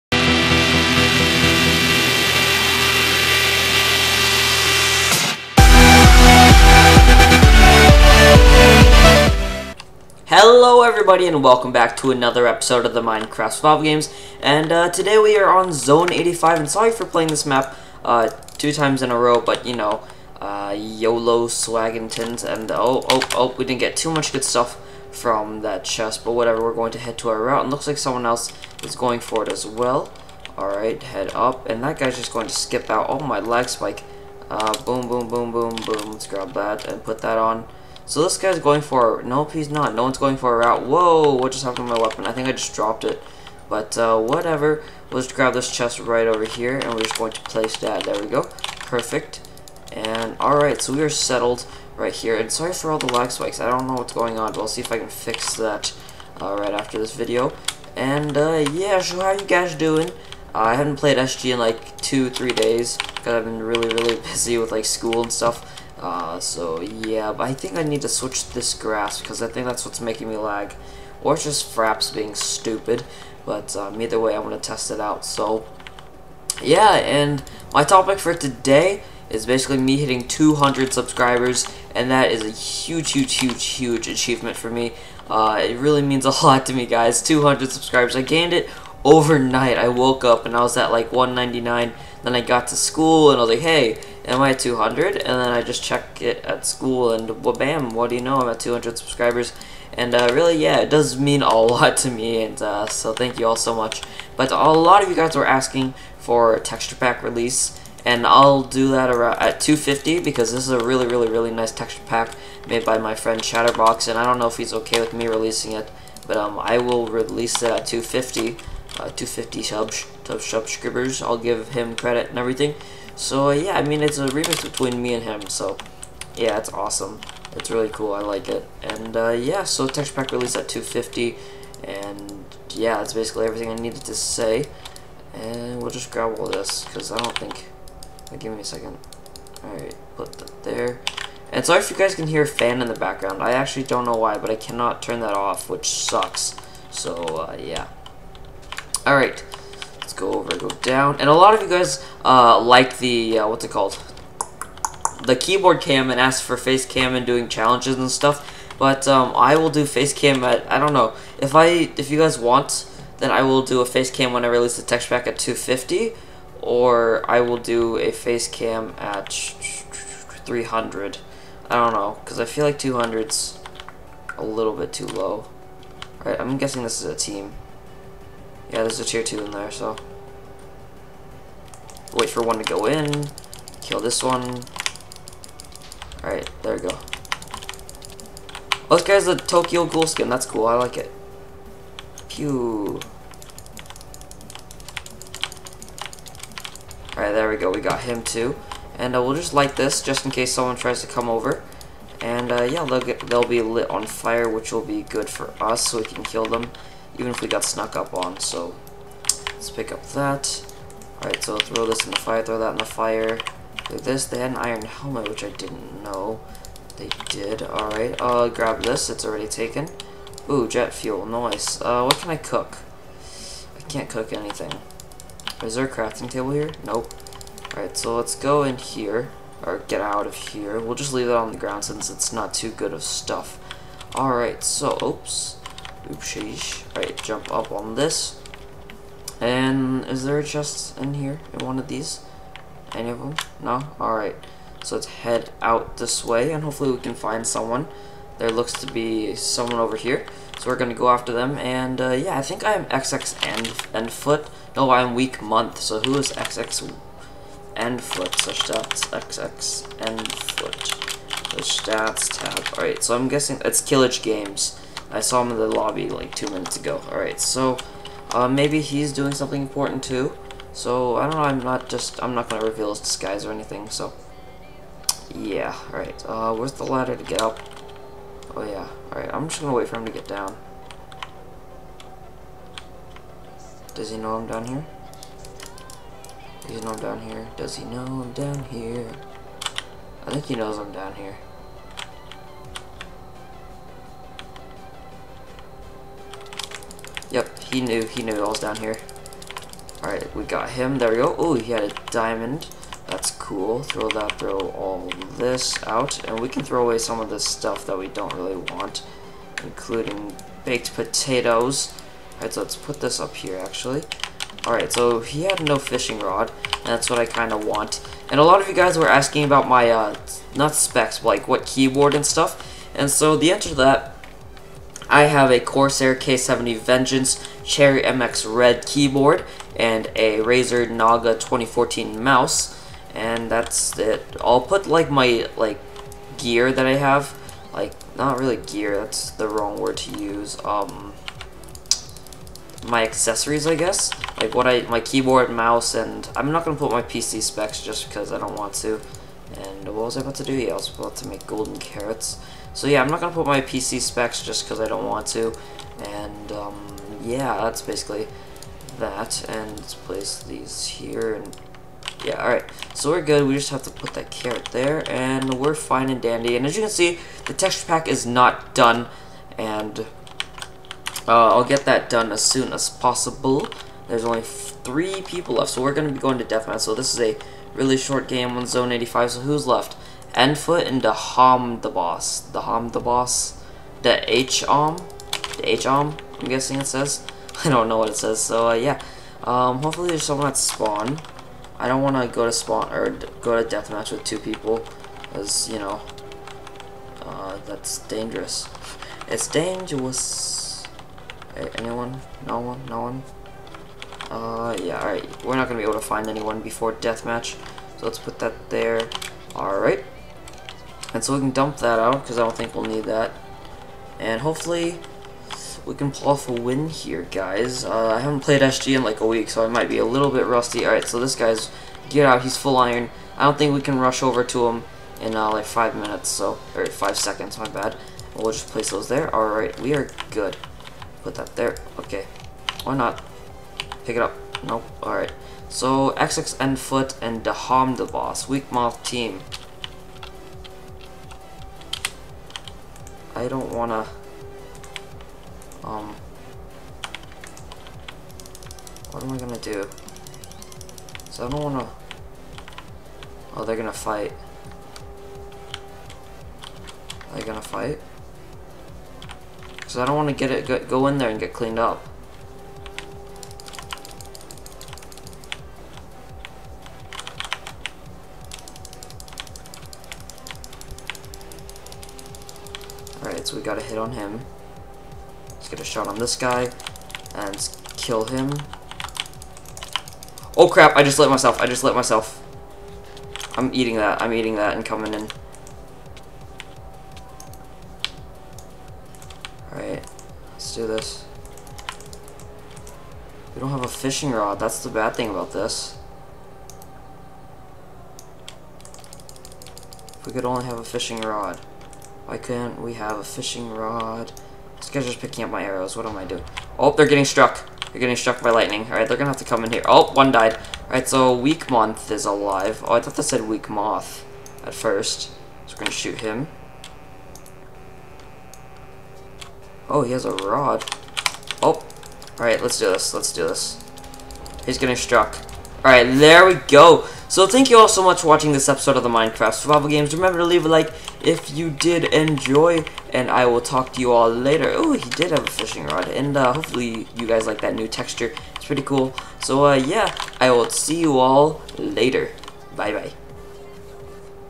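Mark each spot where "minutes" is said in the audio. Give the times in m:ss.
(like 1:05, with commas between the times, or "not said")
4:26, 7:05.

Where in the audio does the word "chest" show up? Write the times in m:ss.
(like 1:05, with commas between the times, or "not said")
0:25, 0:45, 4:00.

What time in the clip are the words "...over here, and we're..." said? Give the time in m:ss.
0:46.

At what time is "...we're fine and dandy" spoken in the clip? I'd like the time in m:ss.
6:05.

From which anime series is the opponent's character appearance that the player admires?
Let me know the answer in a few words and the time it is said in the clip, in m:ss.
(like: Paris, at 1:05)
Tokyo Ghoul, at 3:09.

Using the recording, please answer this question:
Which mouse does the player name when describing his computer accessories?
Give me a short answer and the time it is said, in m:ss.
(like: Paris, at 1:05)
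Razer Naga 2014, at 5:30.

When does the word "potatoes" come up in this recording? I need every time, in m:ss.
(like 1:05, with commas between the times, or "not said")
5:10.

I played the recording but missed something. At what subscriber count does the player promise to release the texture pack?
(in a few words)
250.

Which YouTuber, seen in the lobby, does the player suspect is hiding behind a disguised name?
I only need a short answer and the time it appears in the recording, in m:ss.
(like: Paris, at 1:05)
Killage Games, at 4:23.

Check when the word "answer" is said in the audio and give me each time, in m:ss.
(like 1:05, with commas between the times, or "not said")
5:23.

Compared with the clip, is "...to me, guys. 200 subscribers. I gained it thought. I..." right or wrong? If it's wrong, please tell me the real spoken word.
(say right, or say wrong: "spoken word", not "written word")
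wrong: "overnight", not "thought".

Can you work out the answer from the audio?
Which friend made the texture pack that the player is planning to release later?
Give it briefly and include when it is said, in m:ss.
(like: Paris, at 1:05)
Chatterbox, at 1:53.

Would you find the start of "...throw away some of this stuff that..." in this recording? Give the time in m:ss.
5:06.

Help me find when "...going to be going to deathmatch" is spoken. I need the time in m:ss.
6:15.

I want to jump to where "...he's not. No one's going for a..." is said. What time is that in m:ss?
0:39.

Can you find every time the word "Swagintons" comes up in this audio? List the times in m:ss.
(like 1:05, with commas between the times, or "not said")
0:21.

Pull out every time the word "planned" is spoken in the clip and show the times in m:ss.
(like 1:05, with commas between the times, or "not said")
not said.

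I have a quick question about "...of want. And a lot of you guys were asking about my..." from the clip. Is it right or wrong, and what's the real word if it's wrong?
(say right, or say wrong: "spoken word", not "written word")
right.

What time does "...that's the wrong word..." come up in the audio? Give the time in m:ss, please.
5:38.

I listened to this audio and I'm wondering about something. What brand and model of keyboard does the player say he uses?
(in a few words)
Corsair K70 Vengeance.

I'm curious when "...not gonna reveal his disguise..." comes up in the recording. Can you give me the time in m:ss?
4:32.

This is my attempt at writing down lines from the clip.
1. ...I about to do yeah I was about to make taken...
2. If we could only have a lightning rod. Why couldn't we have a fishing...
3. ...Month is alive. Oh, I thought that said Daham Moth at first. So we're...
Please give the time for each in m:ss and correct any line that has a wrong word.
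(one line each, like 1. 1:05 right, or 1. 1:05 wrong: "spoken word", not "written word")
1. 5:50 wrong: "golden", not "taken"
2. 8:20 wrong: "fishing", not "lightning"
3. 8:31 wrong: "Weak", not "Daham".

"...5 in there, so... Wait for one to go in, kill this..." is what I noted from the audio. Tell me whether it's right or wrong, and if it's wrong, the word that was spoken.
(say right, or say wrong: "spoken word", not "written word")
wrong: "2", not "5".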